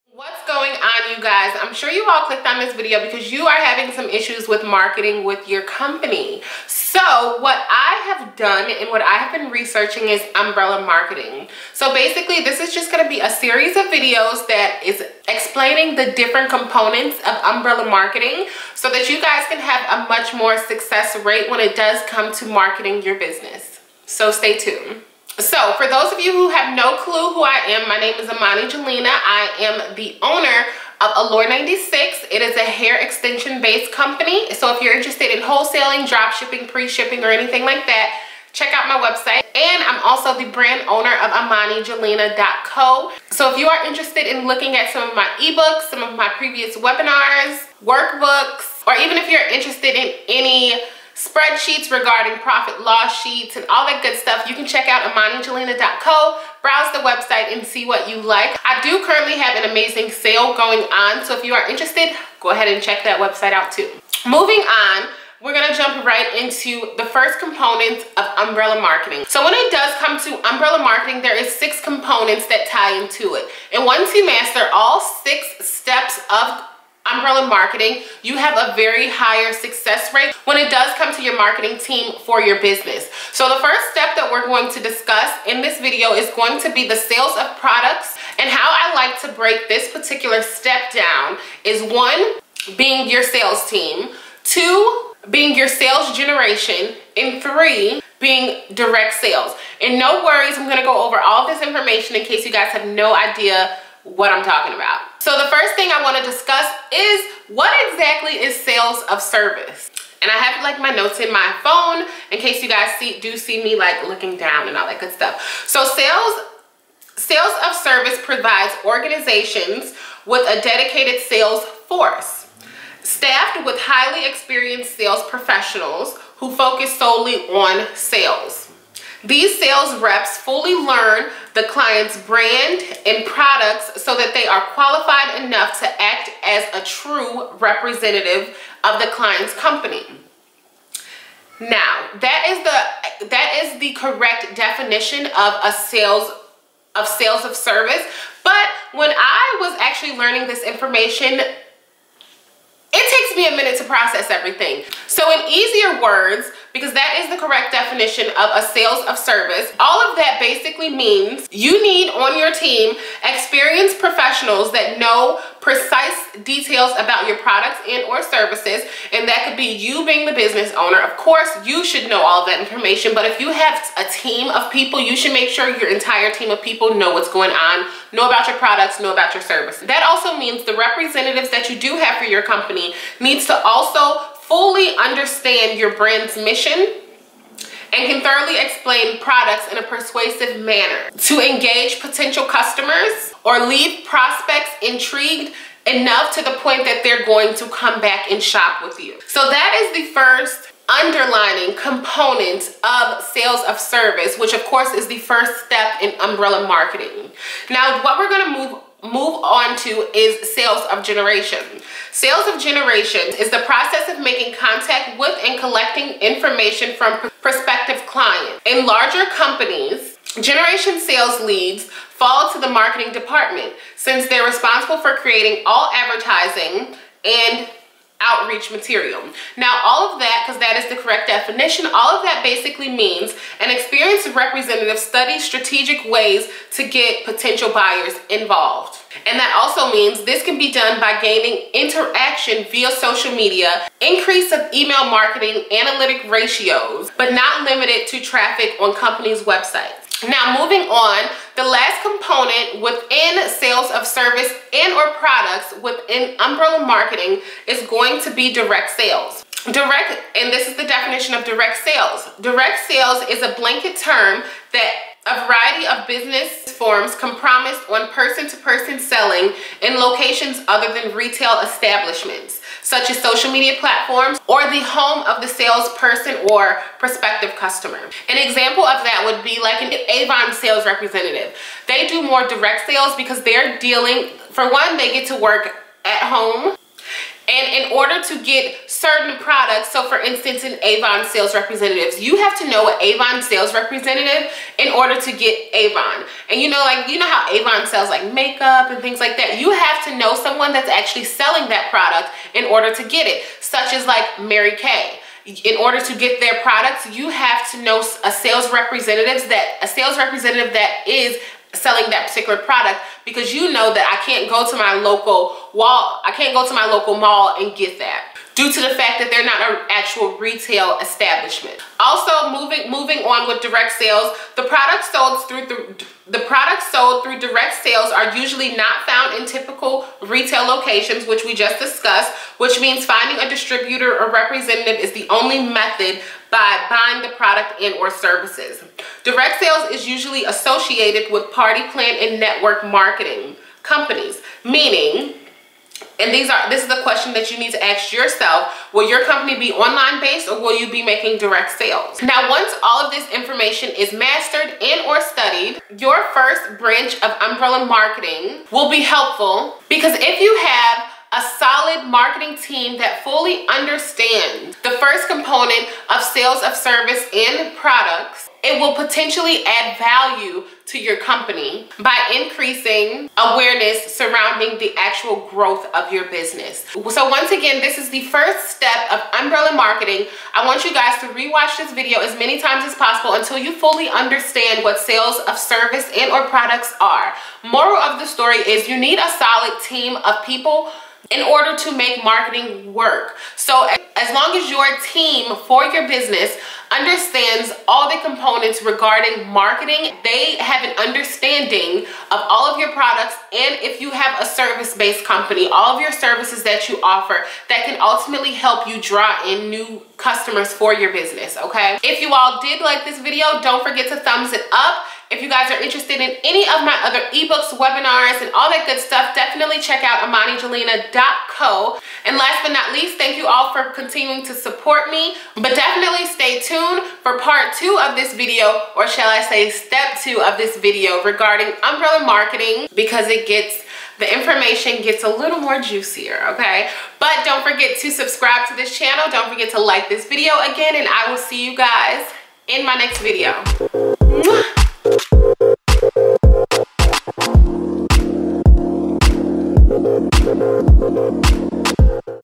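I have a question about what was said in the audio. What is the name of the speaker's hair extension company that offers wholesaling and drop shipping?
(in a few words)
Allure 96.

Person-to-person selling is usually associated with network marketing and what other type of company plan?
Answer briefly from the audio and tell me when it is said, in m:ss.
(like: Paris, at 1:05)
party plan, at 5:41.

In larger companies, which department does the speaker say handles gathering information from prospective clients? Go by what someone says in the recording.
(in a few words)
marketing department.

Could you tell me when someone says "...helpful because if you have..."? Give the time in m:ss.
5:59.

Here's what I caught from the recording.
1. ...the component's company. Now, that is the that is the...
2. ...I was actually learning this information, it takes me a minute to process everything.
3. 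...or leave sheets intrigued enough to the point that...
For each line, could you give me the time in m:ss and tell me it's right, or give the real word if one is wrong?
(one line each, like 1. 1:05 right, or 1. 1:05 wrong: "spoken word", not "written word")
1. 2:18 wrong: "client", not "component"
2. 2:29 right
3. 3:13 wrong: "prospects", not "sheets".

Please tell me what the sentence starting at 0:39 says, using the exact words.
And I'm also the brand owner of ImaniJelena.co.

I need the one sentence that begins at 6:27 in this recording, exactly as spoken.
Moral of the story is you need a solid team of people in order to make marketing work.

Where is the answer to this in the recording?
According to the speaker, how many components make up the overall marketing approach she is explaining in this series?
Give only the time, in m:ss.
1:11.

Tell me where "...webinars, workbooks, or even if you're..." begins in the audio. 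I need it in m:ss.
0:46.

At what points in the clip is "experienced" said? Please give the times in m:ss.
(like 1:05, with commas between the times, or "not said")
2:04, 2:43, 3:53.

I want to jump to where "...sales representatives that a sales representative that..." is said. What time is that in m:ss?
5:08.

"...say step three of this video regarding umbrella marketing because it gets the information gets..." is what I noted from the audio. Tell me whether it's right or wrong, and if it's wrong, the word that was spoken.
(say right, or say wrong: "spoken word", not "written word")
wrong: "two", not "three".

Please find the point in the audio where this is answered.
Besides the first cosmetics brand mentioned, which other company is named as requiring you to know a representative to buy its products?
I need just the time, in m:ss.
5:04.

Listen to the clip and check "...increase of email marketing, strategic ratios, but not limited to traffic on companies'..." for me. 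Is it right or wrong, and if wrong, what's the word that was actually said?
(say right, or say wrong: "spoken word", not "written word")
wrong: "analytic", not "strategic".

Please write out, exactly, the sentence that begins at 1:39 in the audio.
And no worries, I'm gonna go over all this information in case you guys have no idea what I'm talking about.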